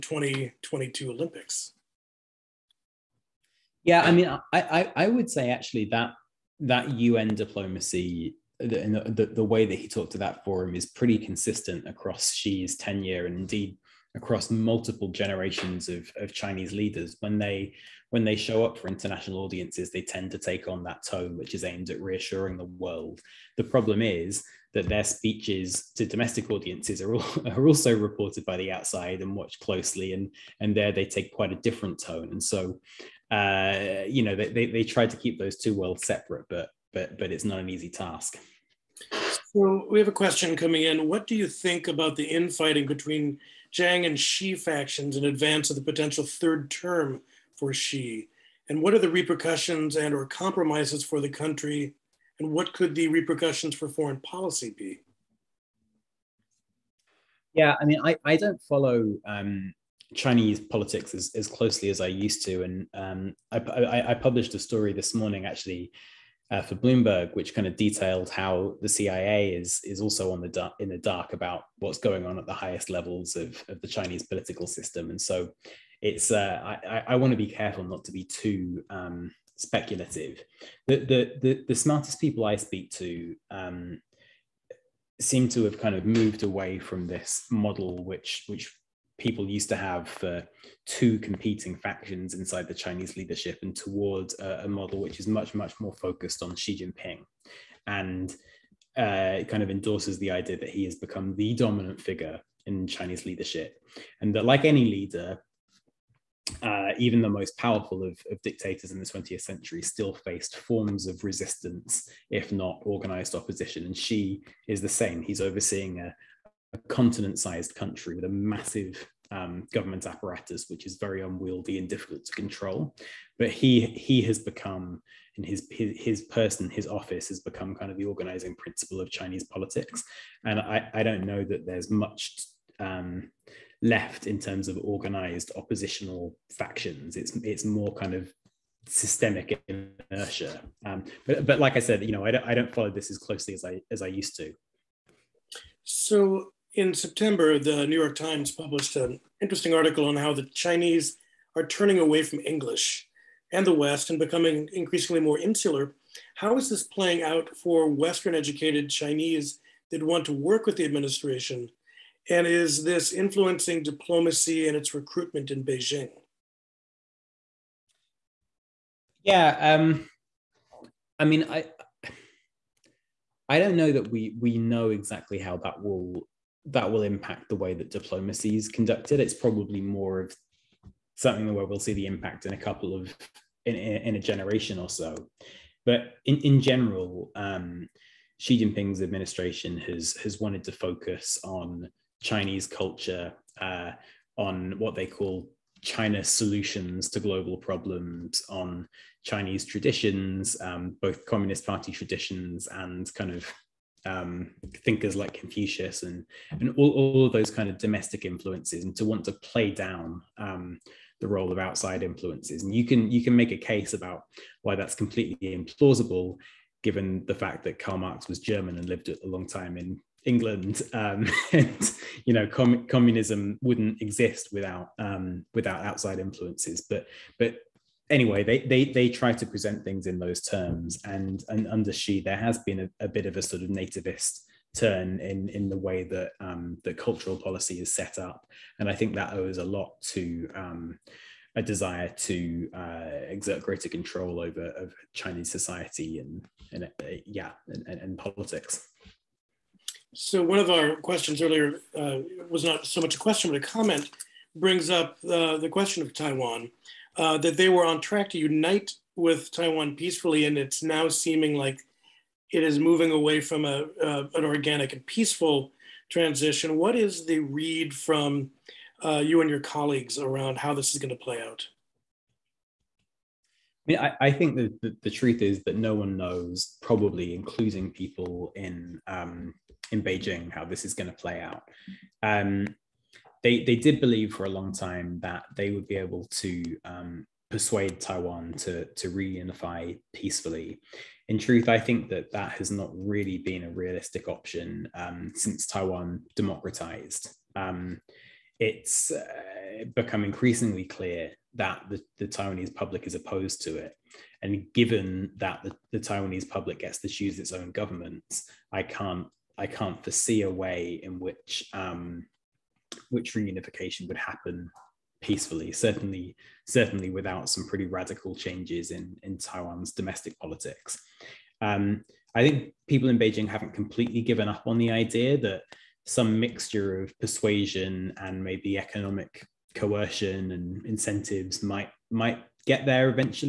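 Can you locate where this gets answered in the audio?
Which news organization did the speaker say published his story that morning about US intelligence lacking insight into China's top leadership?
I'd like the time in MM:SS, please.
01:06.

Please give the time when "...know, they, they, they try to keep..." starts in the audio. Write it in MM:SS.
00:34.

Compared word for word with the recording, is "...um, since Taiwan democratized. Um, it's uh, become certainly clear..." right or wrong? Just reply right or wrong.
wrong.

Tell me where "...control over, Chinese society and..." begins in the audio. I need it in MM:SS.
04:03.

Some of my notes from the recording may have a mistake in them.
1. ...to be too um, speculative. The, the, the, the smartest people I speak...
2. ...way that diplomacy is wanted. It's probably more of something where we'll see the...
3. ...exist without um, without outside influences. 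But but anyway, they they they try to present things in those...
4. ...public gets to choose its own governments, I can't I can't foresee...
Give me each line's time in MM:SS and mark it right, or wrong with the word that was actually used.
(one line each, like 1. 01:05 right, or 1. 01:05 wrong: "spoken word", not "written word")
1. 01:18 right
2. 02:57 wrong: "conducted", not "wanted"
3. 03:44 right
4. 05:06 right.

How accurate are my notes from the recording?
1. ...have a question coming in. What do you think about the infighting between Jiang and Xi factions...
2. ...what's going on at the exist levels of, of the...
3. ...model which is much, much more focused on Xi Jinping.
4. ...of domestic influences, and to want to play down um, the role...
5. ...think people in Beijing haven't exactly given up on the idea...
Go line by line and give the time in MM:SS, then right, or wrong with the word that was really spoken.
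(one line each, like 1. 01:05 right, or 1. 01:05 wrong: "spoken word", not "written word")
1. 00:39 right
2. 01:11 wrong: "highest", not "exist"
3. 01:34 right
4. 03:27 right
5. 05:22 wrong: "completely", not "exactly".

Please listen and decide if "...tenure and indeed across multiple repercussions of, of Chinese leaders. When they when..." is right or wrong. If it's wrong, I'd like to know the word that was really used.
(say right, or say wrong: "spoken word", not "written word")
wrong: "generations", not "repercussions".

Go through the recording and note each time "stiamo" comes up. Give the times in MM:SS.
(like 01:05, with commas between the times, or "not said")
not said.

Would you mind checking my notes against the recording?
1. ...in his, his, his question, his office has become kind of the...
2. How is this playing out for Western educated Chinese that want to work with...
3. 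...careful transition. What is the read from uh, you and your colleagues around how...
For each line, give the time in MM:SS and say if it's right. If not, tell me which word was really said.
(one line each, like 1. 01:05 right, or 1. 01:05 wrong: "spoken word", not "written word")
1. 02:05 wrong: "person", not "question"
2. 02:36 right
3. 04:25 wrong: "peaceful", not "careful".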